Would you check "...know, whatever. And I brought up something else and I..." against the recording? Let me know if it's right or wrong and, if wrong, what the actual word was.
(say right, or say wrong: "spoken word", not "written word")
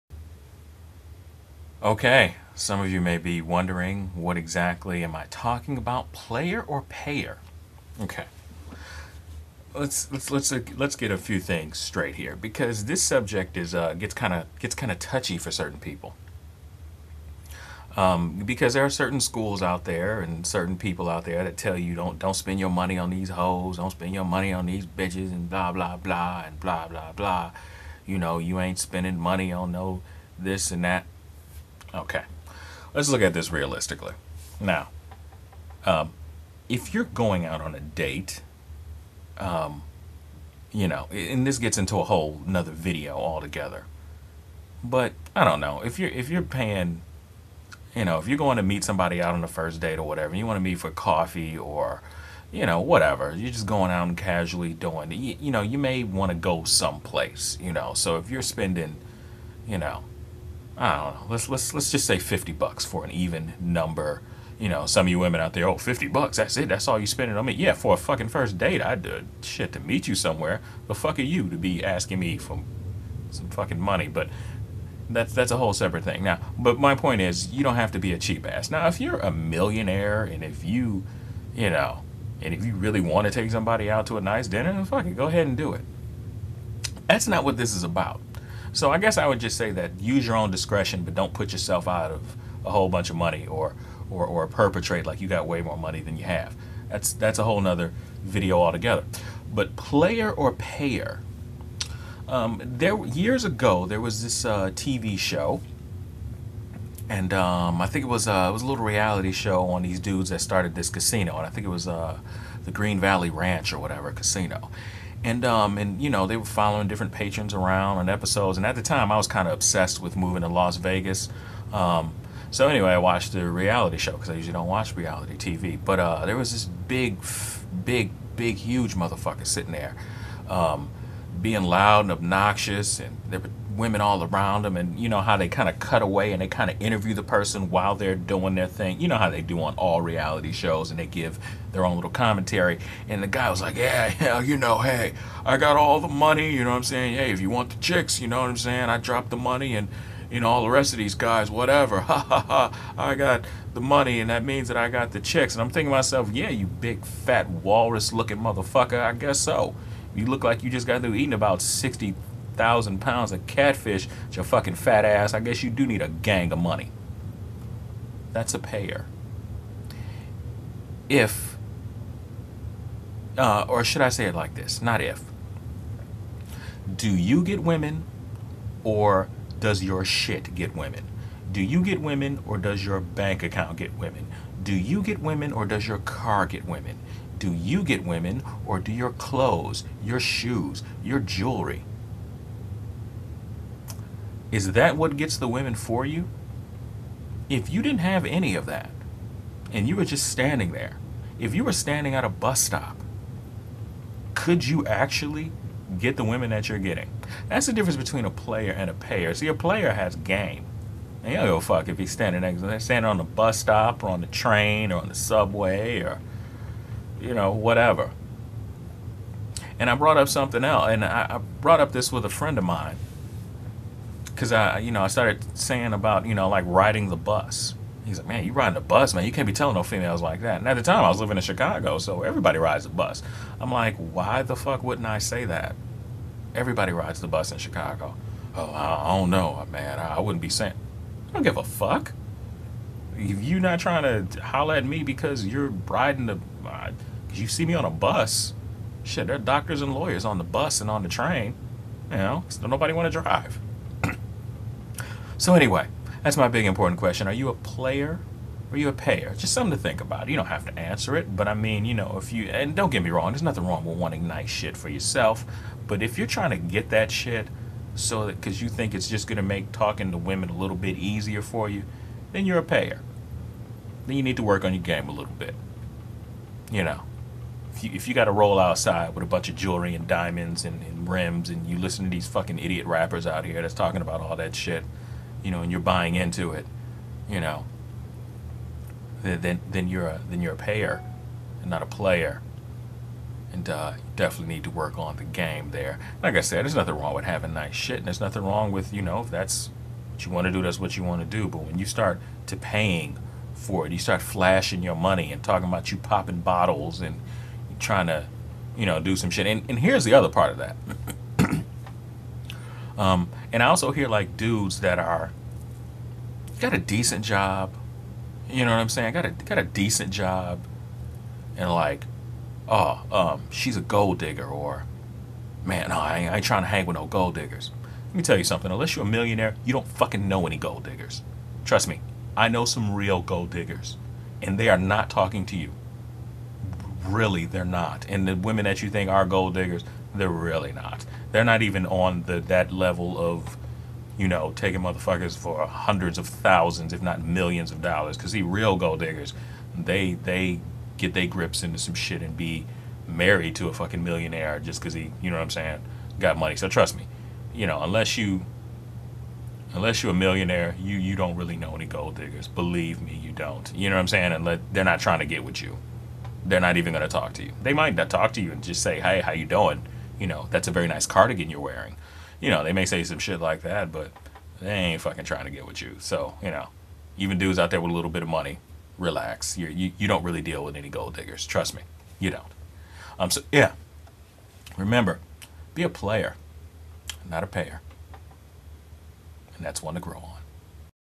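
right.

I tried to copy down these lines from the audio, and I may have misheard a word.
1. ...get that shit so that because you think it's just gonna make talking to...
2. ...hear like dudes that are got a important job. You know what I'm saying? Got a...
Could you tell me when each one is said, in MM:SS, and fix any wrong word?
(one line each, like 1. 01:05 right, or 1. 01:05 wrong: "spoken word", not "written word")
1. 04:26 right
2. 05:13 wrong: "decent", not "important".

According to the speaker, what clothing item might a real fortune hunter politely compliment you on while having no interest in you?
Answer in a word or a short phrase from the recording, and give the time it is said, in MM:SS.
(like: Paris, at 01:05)
cardigan, at 06:11.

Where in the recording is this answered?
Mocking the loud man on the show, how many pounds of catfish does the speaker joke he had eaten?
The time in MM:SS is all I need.
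02:41.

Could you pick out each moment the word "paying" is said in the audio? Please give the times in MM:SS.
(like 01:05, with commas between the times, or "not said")
00:46, 05:02.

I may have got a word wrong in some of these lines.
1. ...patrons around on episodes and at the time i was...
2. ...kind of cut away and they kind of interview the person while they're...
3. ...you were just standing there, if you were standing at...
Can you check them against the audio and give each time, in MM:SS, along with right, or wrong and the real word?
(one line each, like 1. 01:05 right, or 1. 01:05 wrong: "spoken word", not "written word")
1. 01:57 right
2. 02:15 right
3. 03:19 right.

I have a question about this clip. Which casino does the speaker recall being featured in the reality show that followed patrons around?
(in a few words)
Green Valley Ranch.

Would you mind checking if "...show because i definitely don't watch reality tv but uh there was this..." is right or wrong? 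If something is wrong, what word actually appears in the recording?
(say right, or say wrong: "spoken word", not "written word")
wrong: "usually", not "definitely".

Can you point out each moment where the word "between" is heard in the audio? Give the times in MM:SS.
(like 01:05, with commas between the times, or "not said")
03:27.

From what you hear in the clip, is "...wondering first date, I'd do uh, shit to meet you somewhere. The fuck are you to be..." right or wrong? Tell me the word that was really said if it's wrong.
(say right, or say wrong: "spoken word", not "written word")
wrong: "fucking", not "wondering".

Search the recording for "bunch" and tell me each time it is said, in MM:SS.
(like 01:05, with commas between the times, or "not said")
01:32, 04:39.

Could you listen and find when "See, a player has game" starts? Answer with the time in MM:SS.
03:29.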